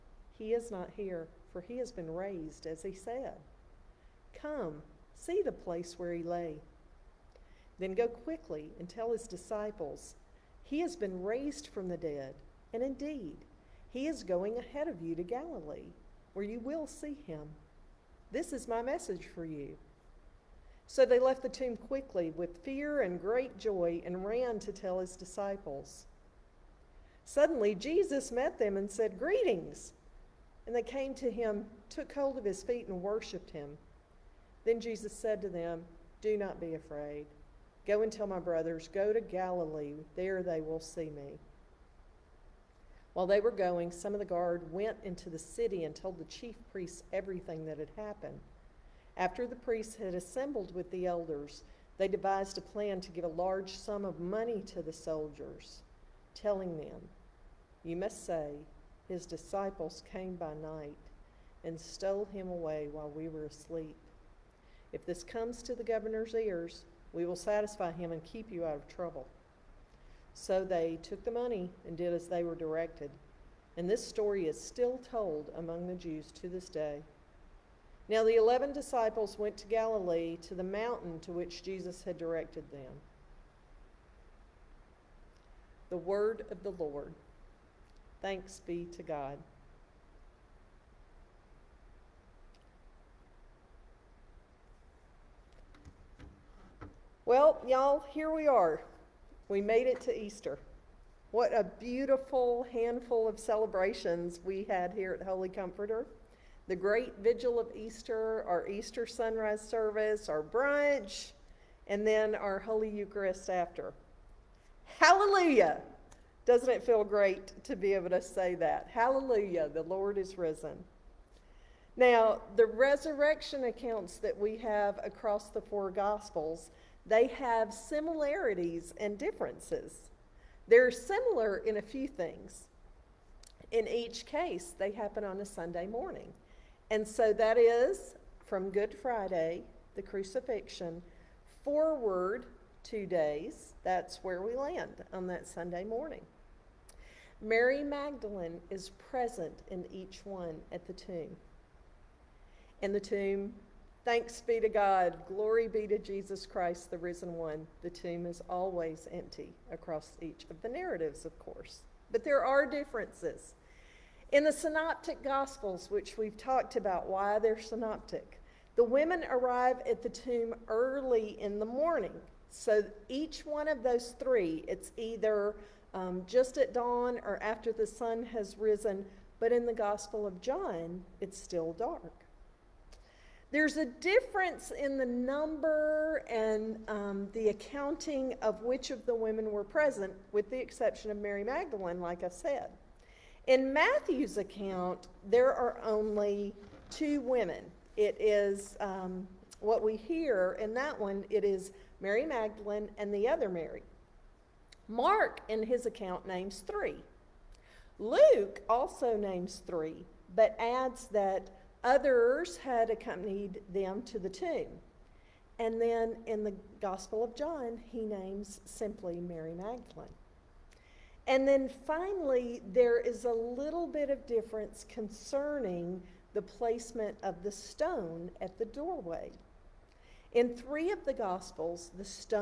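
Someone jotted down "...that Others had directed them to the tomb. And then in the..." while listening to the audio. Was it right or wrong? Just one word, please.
wrong.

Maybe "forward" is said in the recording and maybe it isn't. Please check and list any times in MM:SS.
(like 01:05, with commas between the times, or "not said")
02:21.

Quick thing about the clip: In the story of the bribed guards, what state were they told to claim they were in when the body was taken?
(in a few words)
Asleep.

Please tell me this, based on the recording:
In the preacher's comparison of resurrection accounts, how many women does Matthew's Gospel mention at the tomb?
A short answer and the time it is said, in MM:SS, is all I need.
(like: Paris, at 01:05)
2, at 03:16.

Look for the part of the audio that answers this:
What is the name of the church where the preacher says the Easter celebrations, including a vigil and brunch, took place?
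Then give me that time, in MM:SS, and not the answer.
01:45.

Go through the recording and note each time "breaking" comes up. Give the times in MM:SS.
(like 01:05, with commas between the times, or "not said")
not said.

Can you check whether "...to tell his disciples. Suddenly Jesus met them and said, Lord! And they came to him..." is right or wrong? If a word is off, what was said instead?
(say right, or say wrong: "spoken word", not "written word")
wrong: "Greetings", not "Lord".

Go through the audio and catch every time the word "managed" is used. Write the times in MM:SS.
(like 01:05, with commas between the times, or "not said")
not said.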